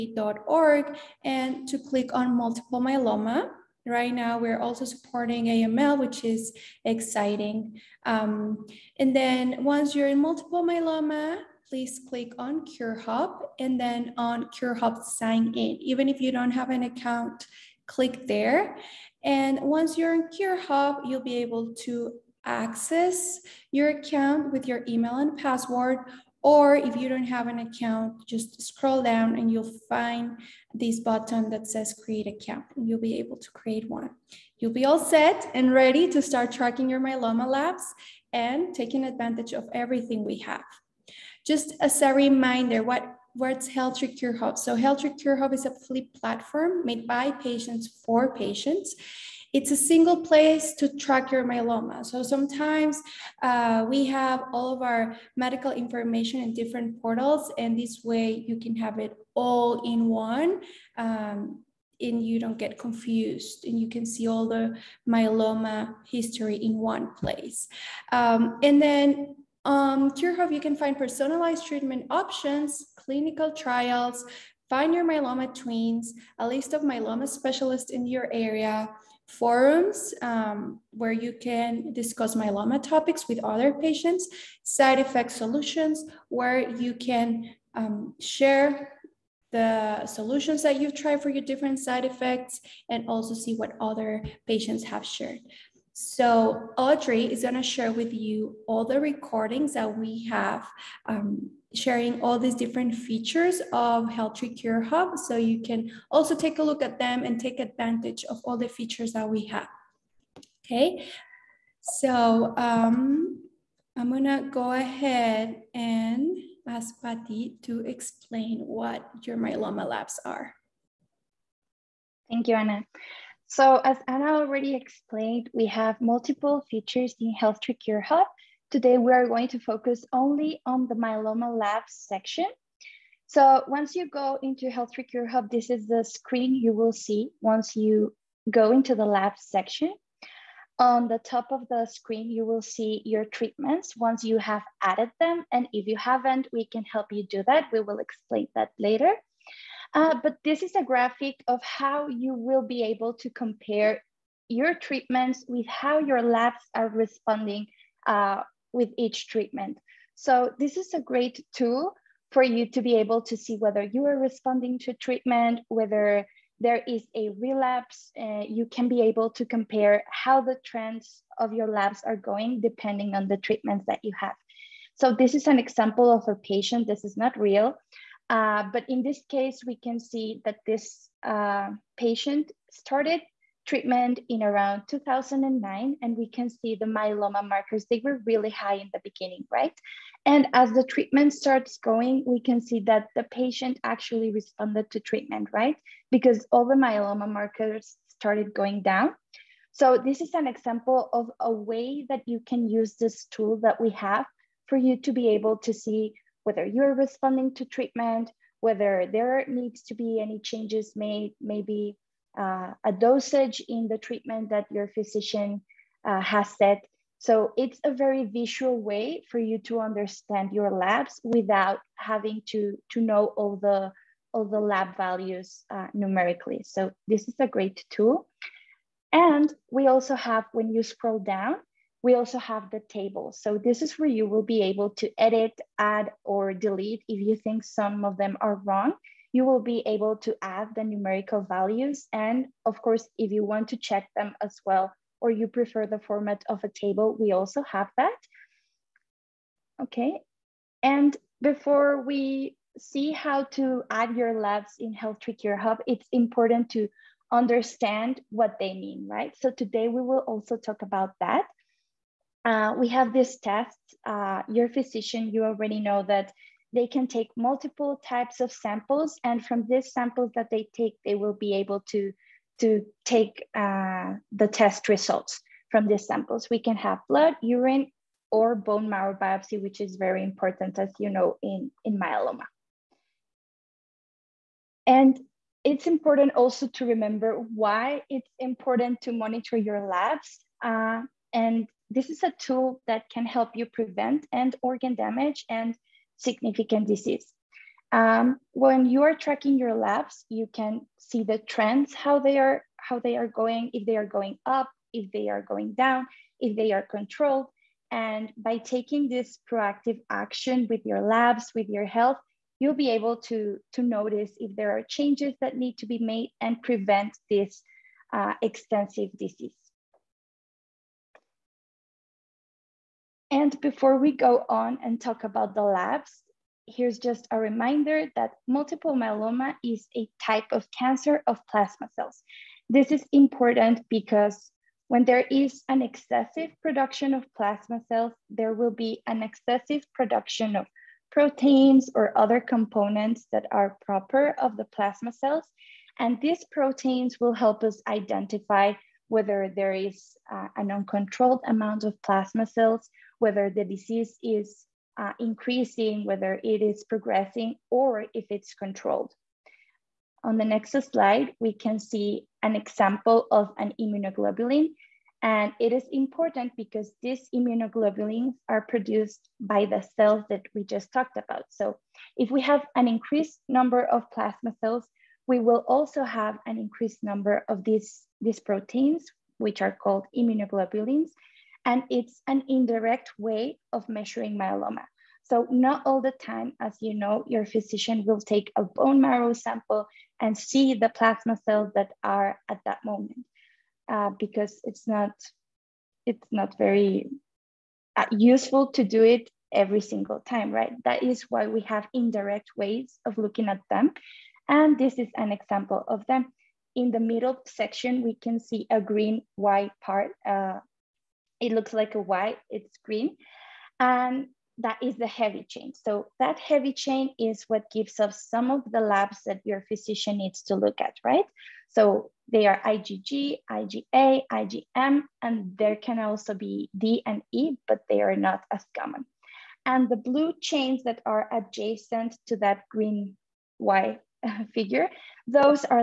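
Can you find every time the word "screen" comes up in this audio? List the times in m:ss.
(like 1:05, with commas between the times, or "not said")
2:16, 2:21.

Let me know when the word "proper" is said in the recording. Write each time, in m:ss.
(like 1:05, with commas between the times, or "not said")
5:43.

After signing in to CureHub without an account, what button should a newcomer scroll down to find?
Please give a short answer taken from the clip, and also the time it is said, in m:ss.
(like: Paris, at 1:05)
create account, at 0:32.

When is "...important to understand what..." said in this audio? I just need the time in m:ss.
4:16.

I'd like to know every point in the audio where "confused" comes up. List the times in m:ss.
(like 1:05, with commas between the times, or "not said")
1:02.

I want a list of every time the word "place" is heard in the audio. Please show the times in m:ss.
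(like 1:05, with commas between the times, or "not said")
0:50, 1:07.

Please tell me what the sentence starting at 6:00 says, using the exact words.
On the next slide, we can see an example of an immunoglobulin.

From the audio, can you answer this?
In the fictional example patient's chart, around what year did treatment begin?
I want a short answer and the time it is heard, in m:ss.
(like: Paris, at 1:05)
2009, at 3:04.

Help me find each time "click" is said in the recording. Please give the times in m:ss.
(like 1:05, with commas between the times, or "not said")
0:01, 0:12, 0:17.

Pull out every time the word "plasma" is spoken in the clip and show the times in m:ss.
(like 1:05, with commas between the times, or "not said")
5:31, 5:37, 5:44, 5:51, 6:14, 6:30.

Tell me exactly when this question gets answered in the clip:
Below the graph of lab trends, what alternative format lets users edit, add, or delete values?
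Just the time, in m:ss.
3:52.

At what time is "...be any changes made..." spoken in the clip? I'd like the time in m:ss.
3:29.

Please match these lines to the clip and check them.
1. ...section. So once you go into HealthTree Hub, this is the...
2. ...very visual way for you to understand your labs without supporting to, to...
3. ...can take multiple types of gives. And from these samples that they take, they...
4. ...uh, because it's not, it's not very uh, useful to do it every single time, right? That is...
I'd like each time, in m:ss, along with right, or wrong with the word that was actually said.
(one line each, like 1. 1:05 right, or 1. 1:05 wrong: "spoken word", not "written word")
1. 2:11 right
2. 3:37 wrong: "having", not "supporting"
3. 4:26 wrong: "samples", not "gives"
4. 6:33 right.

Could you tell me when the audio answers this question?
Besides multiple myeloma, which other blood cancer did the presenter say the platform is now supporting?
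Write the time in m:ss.
0:05.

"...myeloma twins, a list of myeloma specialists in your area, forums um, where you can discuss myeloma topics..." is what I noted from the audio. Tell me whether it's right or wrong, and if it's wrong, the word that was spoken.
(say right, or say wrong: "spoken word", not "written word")
right.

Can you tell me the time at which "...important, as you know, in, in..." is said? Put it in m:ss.
4:40.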